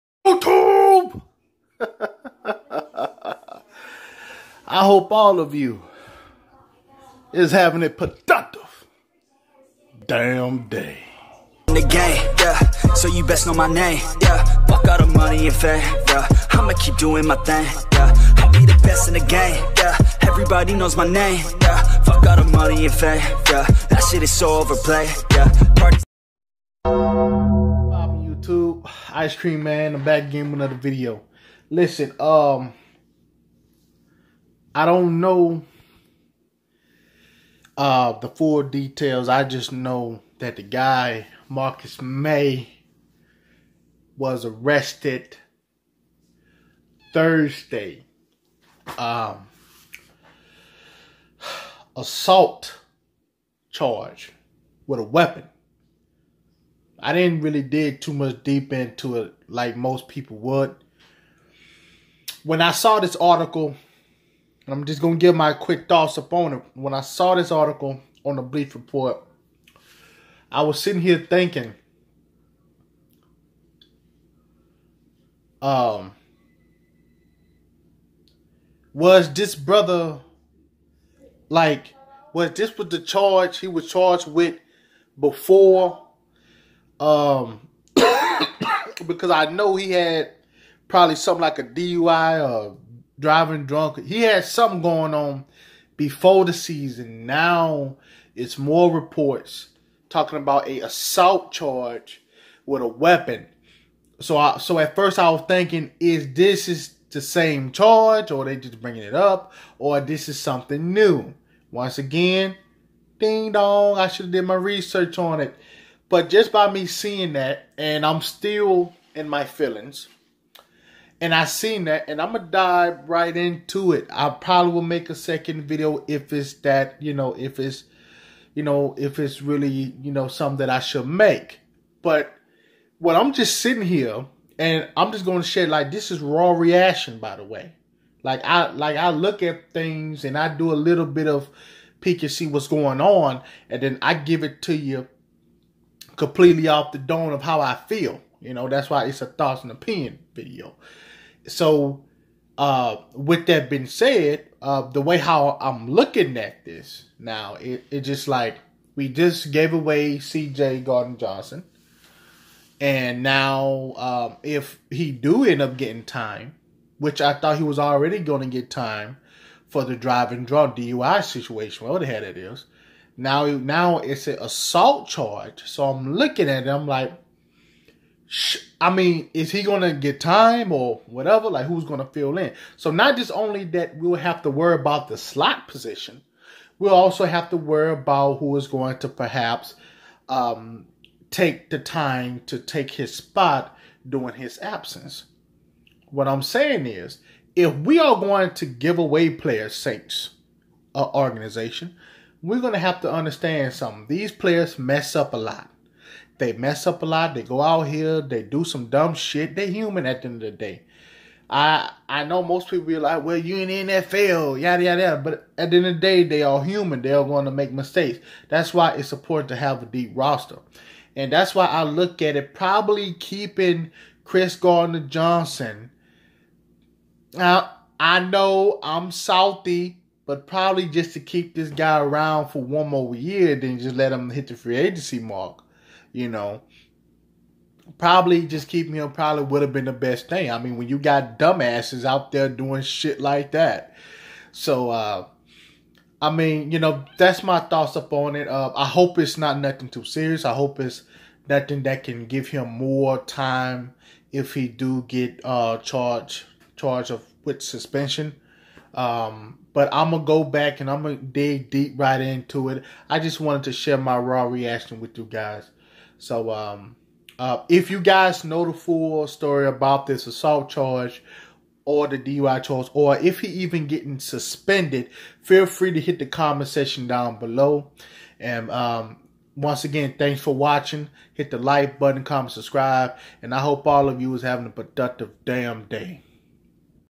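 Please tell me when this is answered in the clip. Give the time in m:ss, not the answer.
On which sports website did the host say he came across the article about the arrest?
1:08.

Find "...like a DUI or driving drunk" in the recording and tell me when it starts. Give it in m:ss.
1:31.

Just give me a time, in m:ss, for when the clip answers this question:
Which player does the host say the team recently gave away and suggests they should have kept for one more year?
2:40.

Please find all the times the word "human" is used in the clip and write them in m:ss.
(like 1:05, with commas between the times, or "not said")
3:29, 3:36.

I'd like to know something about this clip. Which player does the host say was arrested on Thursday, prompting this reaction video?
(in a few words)
Marcus Maye.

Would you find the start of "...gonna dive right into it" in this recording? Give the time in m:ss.
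2:02.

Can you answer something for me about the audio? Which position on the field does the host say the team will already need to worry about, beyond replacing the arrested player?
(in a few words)
slot.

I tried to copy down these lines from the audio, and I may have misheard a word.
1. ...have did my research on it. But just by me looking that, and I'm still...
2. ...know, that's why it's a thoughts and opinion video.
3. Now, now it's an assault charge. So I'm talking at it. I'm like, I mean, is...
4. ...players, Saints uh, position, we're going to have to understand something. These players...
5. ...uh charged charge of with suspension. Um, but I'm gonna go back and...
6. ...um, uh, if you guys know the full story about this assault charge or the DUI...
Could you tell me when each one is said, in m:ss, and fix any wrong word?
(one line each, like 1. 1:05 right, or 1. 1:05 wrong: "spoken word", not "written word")
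1. 1:54 wrong: "seeing", not "looking"
2. 2:28 right
3. 2:53 wrong: "looking", not "talking"
4. 3:19 wrong: "organization", not "position"
5. 4:15 right
6. 4:26 right.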